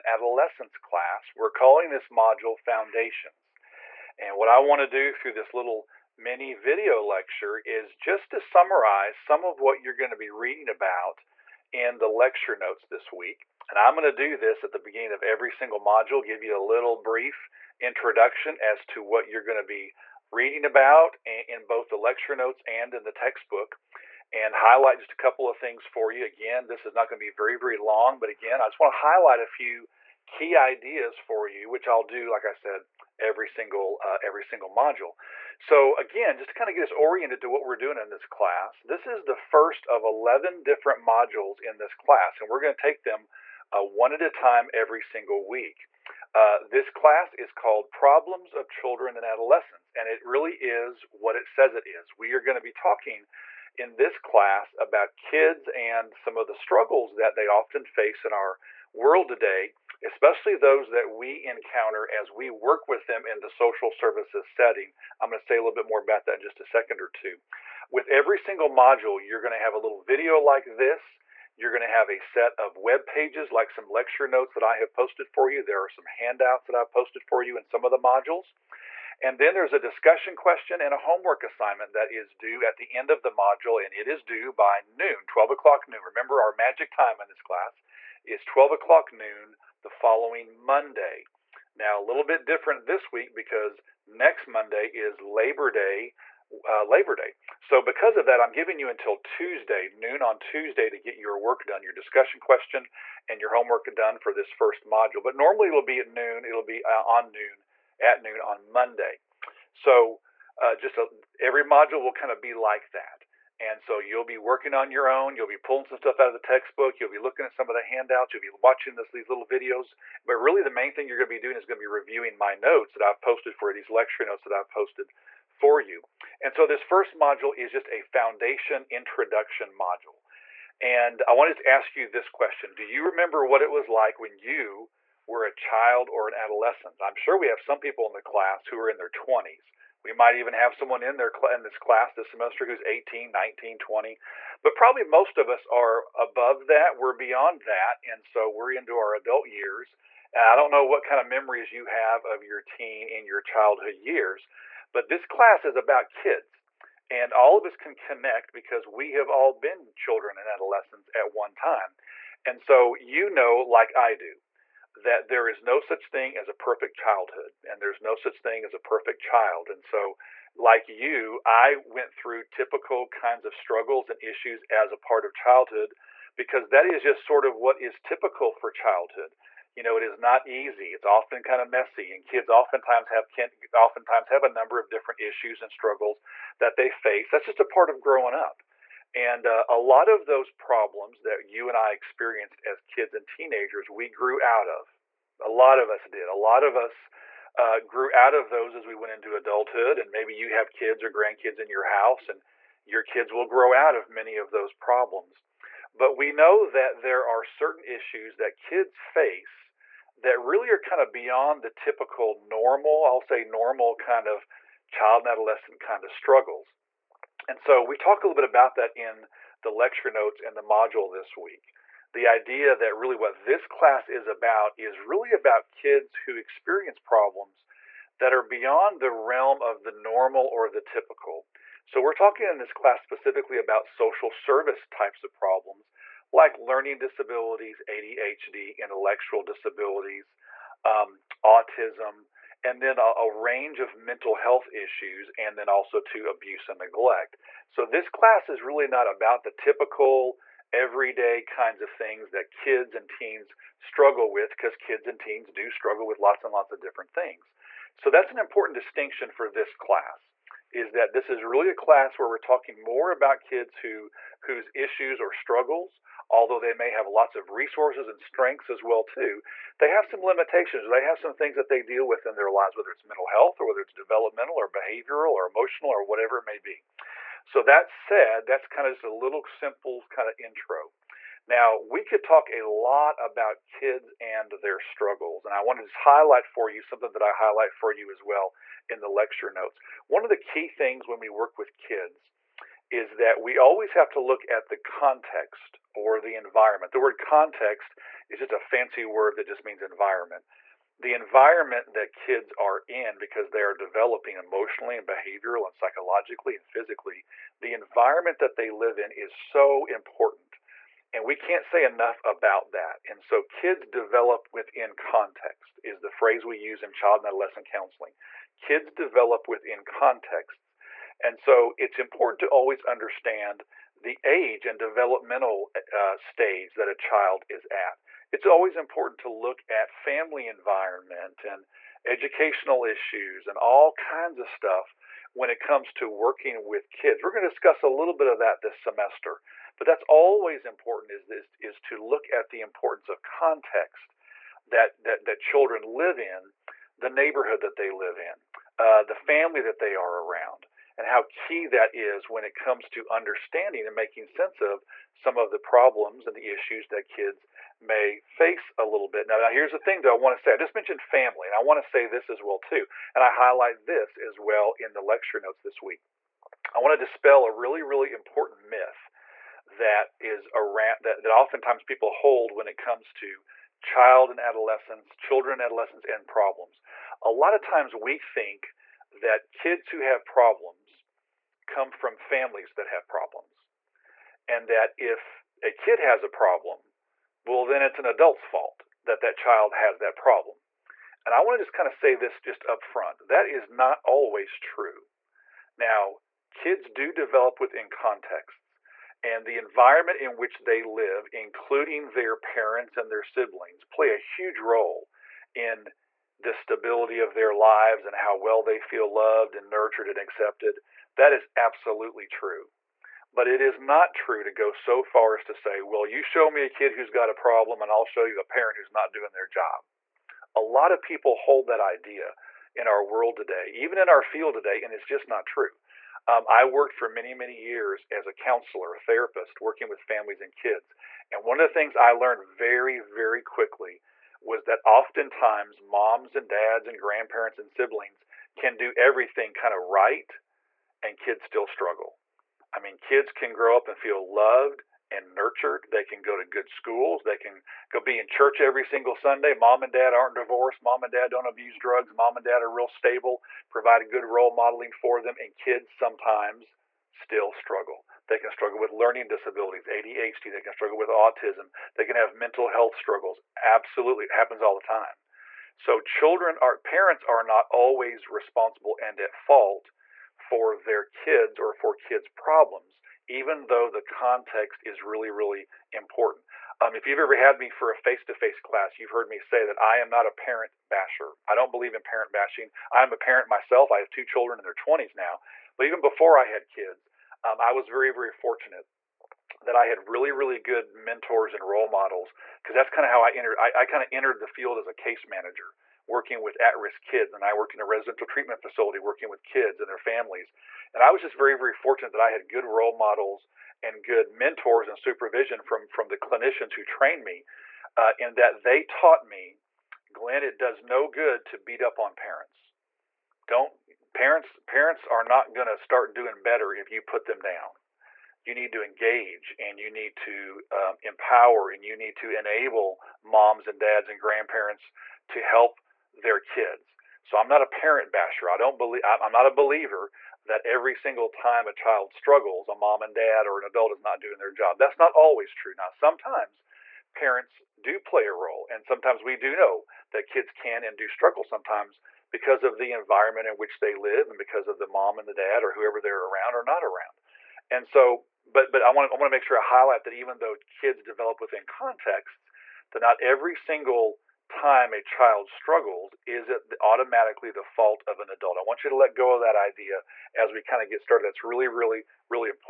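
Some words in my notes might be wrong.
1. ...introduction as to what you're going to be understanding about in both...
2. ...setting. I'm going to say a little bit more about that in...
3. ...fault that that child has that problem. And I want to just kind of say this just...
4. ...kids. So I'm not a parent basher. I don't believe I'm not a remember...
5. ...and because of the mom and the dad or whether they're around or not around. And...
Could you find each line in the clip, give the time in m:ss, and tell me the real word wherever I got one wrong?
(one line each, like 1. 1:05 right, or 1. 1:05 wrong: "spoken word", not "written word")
1. 0:17 wrong: "reading", not "understanding"
2. 1:04 right
3. 6:28 right
4. 8:46 wrong: "believer", not "remember"
5. 9:04 wrong: "whoever", not "whether".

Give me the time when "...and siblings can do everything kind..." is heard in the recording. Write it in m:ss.
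7:17.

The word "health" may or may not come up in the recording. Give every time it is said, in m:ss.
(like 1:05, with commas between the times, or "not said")
4:04, 4:33, 7:42.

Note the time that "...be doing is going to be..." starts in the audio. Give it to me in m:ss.
2:01.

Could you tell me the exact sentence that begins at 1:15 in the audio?
There are some handouts that I've posted for you in some of the modules.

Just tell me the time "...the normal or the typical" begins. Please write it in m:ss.
3:49.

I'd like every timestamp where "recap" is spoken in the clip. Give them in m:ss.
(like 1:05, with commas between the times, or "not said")
not said.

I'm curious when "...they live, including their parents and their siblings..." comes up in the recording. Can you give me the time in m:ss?
6:40.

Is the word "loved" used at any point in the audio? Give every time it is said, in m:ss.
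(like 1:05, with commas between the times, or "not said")
6:49, 7:24.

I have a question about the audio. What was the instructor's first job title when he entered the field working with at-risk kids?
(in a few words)
case manager.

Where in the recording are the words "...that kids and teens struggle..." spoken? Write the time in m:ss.
4:12.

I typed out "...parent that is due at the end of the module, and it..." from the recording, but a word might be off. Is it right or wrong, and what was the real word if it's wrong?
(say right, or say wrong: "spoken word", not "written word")
wrong: "assignment", not "parent".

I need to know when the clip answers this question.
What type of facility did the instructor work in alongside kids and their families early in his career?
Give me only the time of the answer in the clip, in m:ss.
8:17.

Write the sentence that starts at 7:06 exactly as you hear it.
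Um, I worked for many, many years as a counselor, a therapist, working with families and kids.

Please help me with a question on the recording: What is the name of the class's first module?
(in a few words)
Foundations.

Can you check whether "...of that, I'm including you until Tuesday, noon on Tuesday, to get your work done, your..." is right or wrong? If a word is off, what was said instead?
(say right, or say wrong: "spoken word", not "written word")
wrong: "giving", not "including".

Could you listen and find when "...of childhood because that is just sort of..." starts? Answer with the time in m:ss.
2:55.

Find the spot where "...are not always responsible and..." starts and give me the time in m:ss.
7:47.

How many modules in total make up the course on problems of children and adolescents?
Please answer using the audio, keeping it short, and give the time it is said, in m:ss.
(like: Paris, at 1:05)
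11, at 0:40.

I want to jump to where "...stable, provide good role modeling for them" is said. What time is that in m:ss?
7:32.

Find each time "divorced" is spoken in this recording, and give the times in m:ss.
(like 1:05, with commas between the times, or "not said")
7:30.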